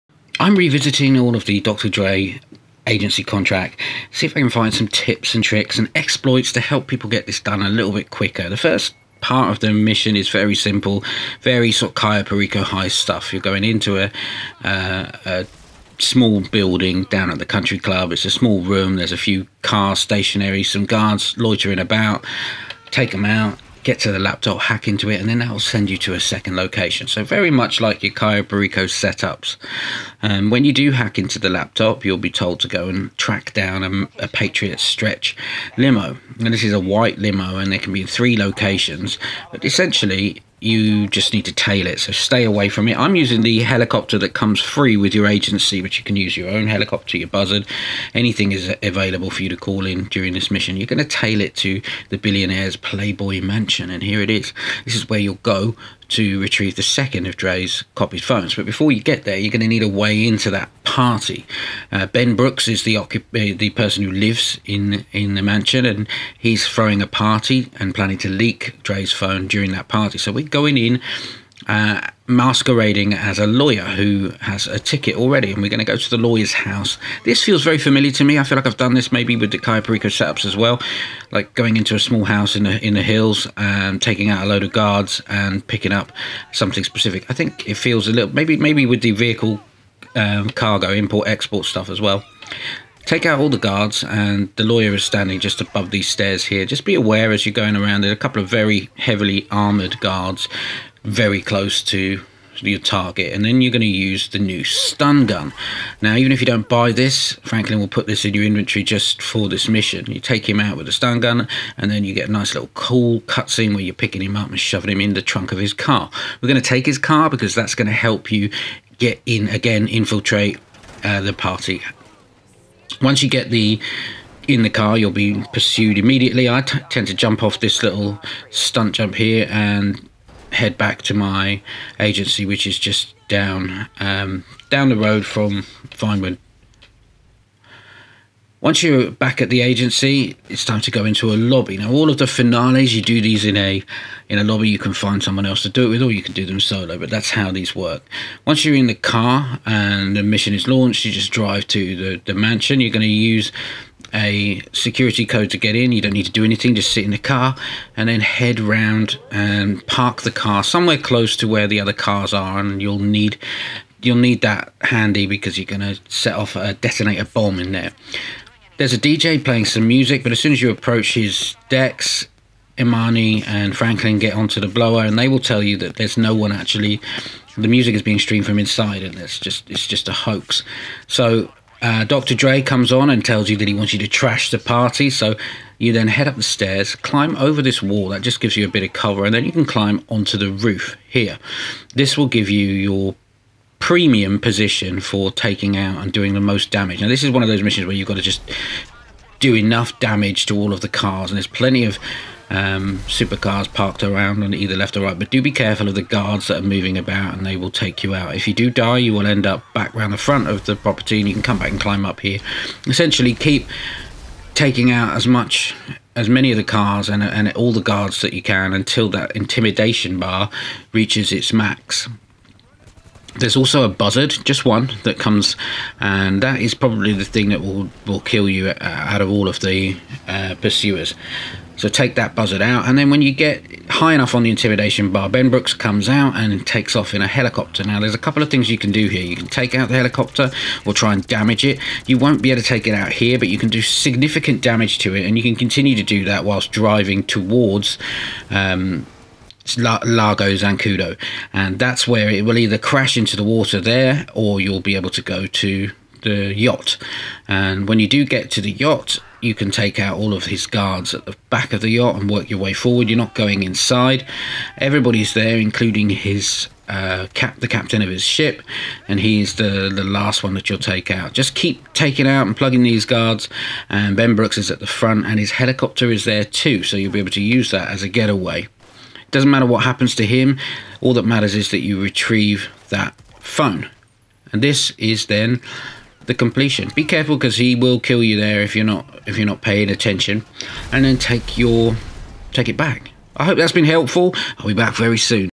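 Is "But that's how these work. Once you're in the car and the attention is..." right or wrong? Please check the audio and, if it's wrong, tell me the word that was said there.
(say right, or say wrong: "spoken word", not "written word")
wrong: "mission", not "attention".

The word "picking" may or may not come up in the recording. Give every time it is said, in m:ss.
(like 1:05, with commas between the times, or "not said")
1:25, 1:53.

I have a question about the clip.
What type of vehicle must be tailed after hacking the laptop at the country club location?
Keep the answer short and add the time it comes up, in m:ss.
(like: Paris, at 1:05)
Patriot Stretch limo, at 0:34.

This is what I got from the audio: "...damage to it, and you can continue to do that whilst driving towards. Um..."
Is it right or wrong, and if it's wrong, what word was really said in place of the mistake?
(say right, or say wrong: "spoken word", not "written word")
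right.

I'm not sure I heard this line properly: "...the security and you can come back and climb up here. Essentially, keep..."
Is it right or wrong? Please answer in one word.
wrong.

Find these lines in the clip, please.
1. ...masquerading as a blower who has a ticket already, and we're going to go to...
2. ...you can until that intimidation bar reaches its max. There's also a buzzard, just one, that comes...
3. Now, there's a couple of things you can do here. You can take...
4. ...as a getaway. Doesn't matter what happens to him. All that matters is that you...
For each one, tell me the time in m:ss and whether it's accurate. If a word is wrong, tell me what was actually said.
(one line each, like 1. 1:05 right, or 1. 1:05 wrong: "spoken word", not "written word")
1. 1:12 wrong: "lawyer", not "blower"
2. 3:38 right
3. 3:57 right
4. 4:37 right.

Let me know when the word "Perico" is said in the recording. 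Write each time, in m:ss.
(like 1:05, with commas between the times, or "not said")
0:12, 0:28.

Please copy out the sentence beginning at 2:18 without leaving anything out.
Once you're back at the agency, it's time to go into a lobby.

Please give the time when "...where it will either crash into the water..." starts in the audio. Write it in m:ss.
4:12.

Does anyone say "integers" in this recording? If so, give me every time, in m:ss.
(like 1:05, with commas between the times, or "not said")
not said.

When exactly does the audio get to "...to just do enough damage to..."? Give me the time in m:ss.
3:18.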